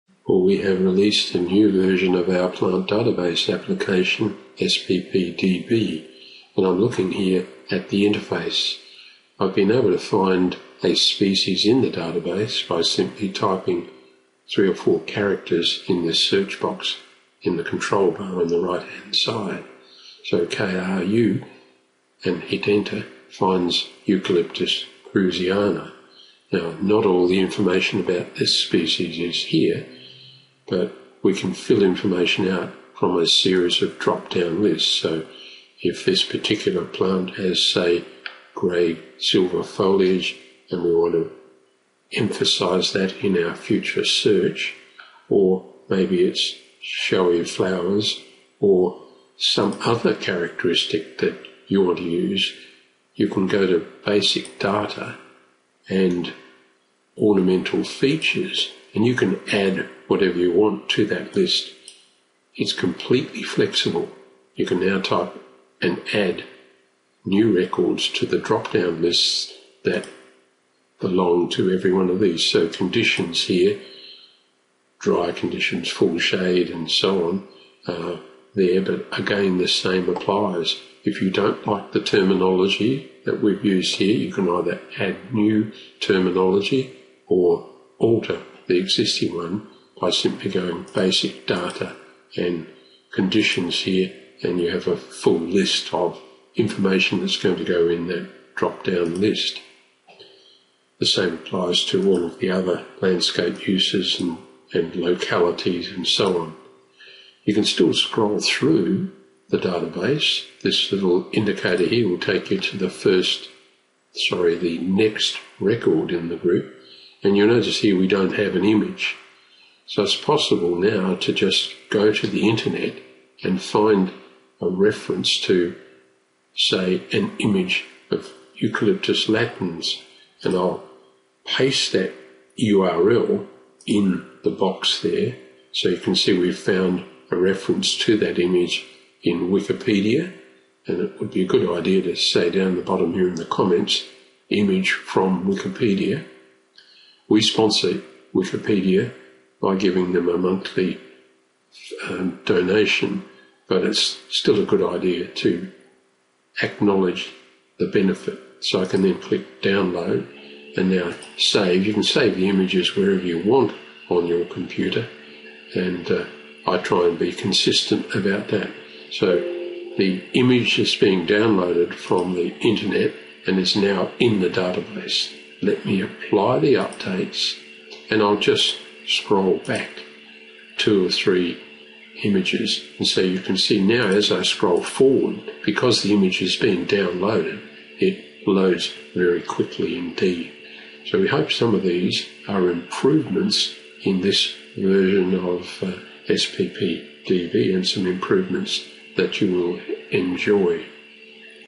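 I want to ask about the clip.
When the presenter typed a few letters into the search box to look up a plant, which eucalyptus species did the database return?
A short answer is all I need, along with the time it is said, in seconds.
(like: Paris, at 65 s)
Eucalyptus kruseana, at 24 s.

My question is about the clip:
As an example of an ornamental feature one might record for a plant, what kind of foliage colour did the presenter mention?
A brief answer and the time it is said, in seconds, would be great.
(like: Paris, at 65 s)
grey silver, at 38 s.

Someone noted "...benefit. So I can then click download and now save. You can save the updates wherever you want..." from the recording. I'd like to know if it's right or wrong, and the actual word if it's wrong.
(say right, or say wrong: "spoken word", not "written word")
wrong: "images", not "updates".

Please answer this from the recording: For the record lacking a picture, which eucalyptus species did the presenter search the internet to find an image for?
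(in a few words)
Eucalyptus latens.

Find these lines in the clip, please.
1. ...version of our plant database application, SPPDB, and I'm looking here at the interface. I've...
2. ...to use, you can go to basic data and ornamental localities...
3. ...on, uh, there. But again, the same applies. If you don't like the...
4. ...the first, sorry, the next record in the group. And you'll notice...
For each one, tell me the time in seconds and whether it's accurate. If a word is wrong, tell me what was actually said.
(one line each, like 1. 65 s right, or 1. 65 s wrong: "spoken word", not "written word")
1. 1 s right
2. 51 s wrong: "features", not "localities"
3. 77 s right
4. 112 s right.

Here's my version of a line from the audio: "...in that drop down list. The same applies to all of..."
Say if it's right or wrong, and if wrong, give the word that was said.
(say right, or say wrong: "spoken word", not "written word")
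right.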